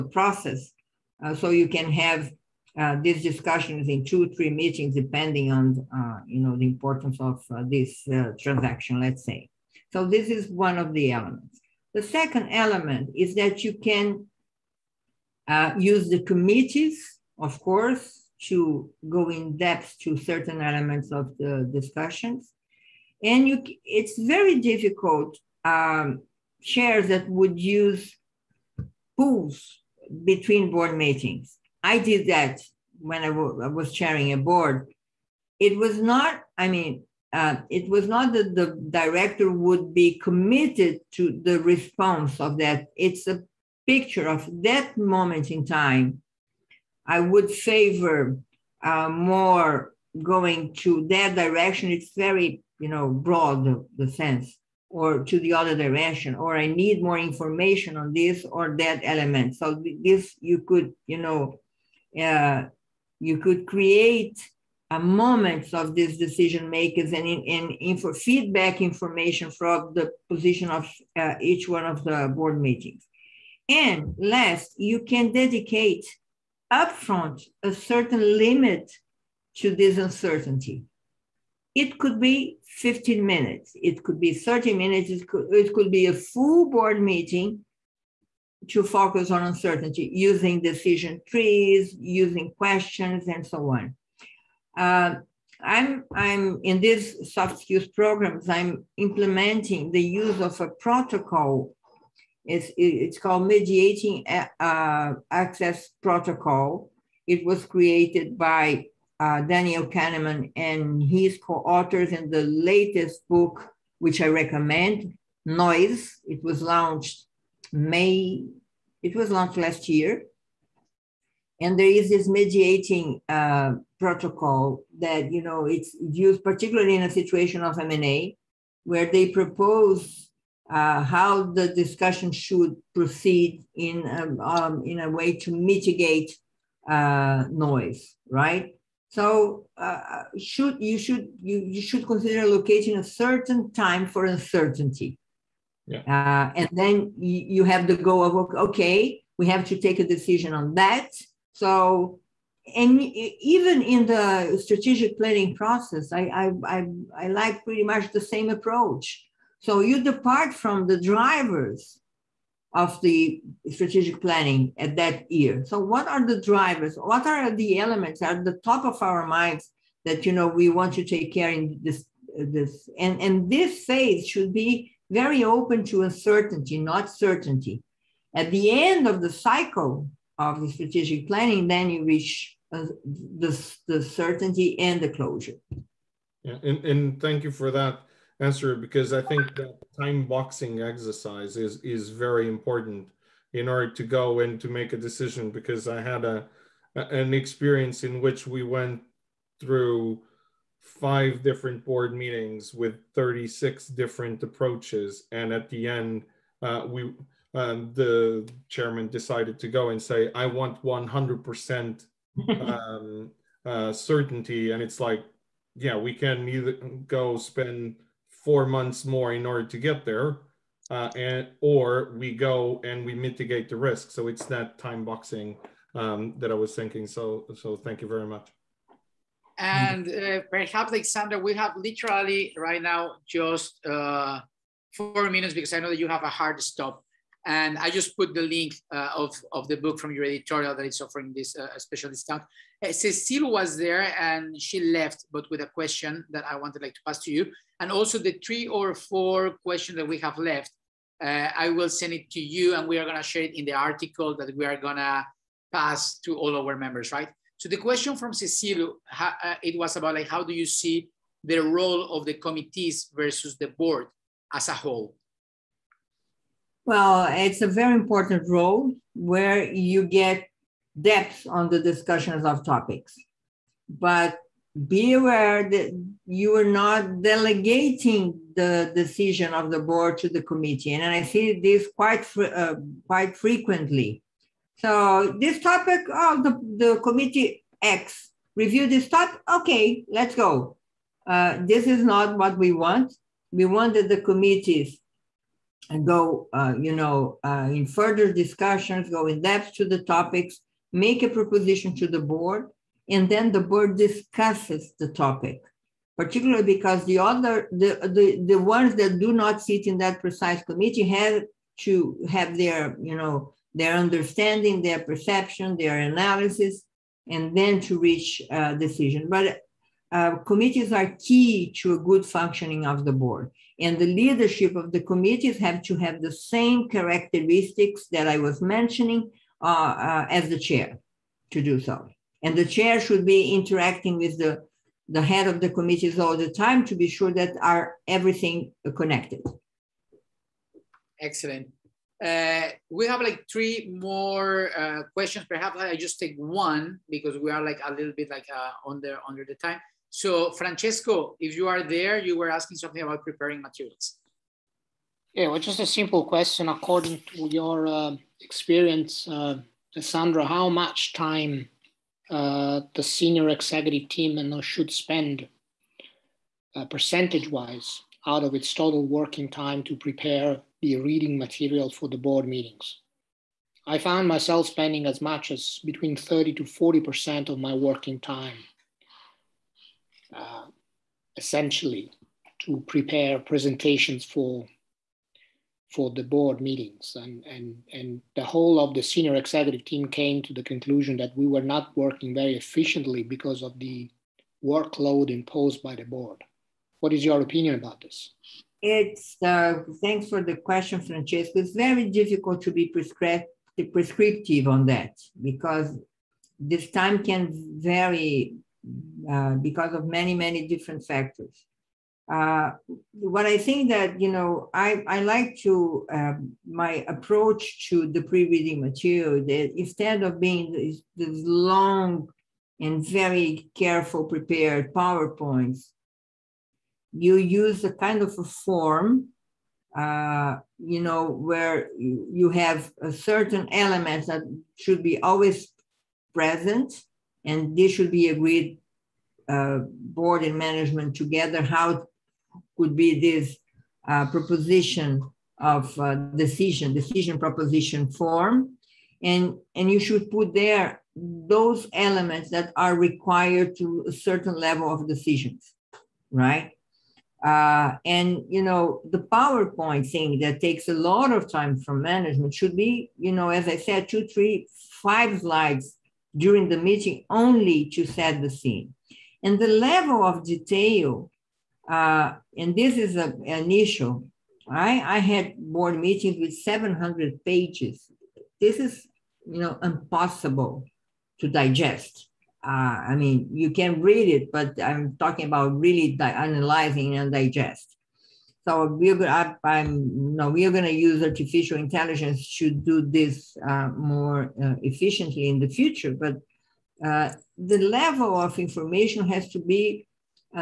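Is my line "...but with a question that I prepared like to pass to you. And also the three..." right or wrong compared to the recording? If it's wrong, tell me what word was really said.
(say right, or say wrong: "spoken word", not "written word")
wrong: "wanted", not "prepared".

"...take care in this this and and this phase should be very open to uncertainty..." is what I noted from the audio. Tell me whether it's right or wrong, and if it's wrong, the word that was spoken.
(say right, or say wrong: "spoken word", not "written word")
right.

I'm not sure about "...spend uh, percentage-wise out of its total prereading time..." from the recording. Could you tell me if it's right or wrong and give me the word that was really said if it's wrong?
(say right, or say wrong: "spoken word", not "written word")
wrong: "working", not "prereading".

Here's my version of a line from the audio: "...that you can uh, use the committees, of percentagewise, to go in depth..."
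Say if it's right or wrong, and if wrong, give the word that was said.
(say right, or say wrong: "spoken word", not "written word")
wrong: "course", not "percentagewise".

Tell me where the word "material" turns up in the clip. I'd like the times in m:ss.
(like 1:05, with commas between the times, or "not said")
5:53, 6:11, 6:58.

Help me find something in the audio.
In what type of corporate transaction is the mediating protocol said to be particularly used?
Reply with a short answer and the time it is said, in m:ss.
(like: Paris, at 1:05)
M&A, at 2:07.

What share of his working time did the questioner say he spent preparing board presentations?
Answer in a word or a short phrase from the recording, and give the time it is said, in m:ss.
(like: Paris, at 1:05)
30 to 40%, at 6:16.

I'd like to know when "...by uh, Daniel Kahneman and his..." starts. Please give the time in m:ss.
1:48.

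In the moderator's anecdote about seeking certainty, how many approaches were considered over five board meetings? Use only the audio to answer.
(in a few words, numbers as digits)
36.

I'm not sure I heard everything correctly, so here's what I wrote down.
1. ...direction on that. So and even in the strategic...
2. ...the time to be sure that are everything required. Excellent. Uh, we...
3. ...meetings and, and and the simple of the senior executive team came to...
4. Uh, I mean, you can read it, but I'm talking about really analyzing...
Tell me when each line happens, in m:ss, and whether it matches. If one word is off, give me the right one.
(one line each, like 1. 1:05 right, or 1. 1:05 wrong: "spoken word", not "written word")
1. 2:30 wrong: "decision", not "direction"
2. 5:36 wrong: "connected", not "required"
3. 6:26 wrong: "whole", not "simple"
4. 8:02 right.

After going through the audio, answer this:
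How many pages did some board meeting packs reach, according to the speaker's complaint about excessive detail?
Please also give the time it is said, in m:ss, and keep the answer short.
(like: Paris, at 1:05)
700, at 7:56.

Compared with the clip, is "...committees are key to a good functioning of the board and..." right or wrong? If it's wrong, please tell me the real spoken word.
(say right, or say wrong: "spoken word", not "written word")
right.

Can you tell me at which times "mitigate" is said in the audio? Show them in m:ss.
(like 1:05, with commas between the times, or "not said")
2:15, 3:43.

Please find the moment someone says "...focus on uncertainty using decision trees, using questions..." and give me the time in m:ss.
1:28.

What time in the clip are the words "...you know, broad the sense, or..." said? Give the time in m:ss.
0:52.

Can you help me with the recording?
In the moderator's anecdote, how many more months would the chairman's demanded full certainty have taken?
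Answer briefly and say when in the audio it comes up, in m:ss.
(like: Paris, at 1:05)
4, at 3:38.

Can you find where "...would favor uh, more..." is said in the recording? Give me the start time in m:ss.
0:47.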